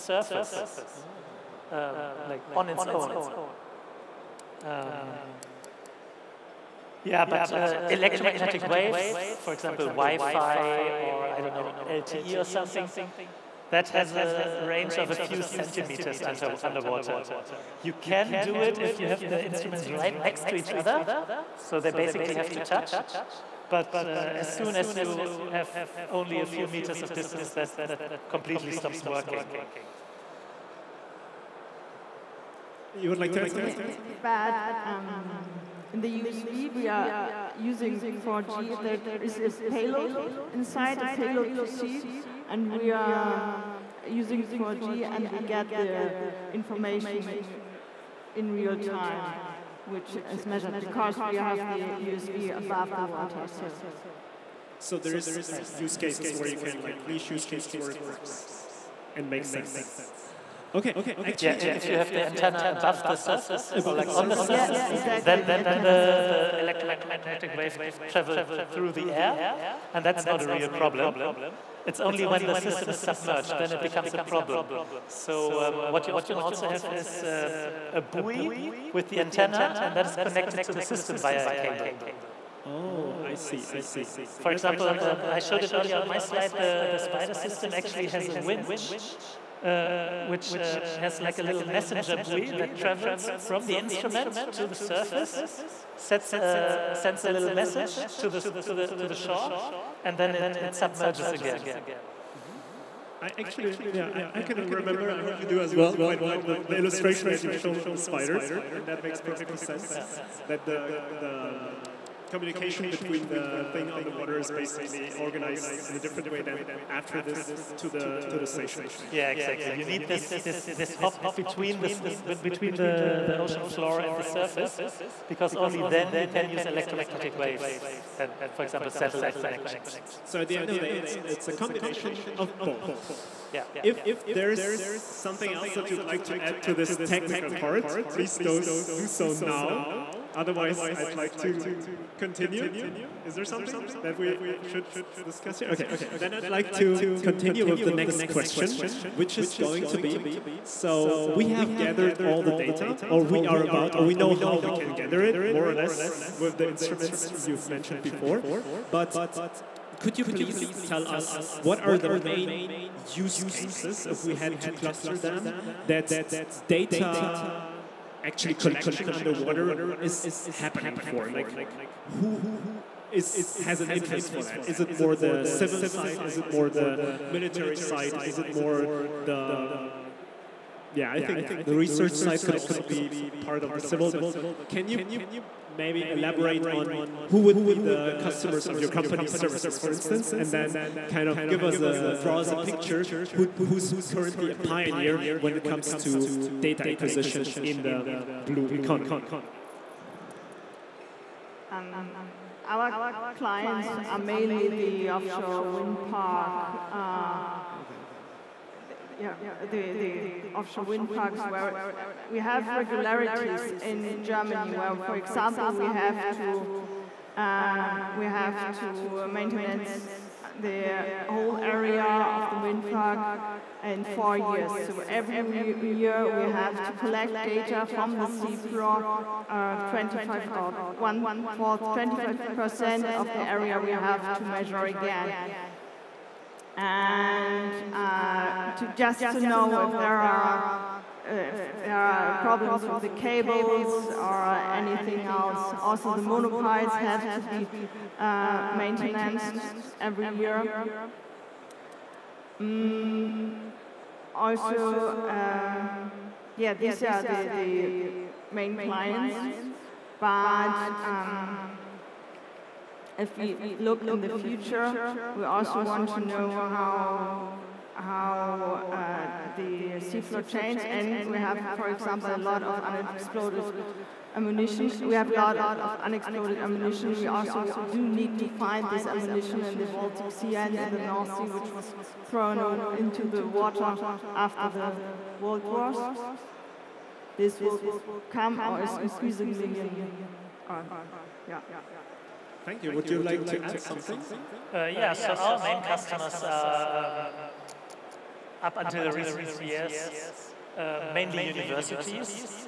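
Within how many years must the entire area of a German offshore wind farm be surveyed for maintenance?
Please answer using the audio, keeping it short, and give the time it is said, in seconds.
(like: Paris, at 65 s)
4, at 224 s.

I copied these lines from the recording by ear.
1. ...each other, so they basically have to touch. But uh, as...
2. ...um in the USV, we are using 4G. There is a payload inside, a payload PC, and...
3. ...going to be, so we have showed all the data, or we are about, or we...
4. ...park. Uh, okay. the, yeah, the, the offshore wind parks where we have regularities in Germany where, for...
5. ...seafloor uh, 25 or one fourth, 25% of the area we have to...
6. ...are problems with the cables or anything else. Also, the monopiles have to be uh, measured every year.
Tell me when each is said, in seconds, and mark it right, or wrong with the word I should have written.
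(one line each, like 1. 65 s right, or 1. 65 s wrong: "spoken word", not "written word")
1. 20 s right
2. 34 s right
3. 149 s wrong: "gathered", not "showed"
4. 206 s right
5. 228 s right
6. 241 s wrong: "maintained", not "measured".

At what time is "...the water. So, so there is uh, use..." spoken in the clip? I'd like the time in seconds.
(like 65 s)
52 s.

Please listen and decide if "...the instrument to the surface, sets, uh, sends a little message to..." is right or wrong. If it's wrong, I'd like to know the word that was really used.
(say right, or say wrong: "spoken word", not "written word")
right.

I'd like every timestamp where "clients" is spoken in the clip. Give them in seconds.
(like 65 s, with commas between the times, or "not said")
203 s, 258 s.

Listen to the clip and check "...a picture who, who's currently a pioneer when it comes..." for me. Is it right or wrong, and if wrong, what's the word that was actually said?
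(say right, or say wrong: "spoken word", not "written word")
right.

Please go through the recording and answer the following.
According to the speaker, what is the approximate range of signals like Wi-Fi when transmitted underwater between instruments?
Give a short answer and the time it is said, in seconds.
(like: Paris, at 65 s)
a few centimeters, at 15 s.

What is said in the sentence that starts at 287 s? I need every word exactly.
This will come or is increasingly in, uh, yeah.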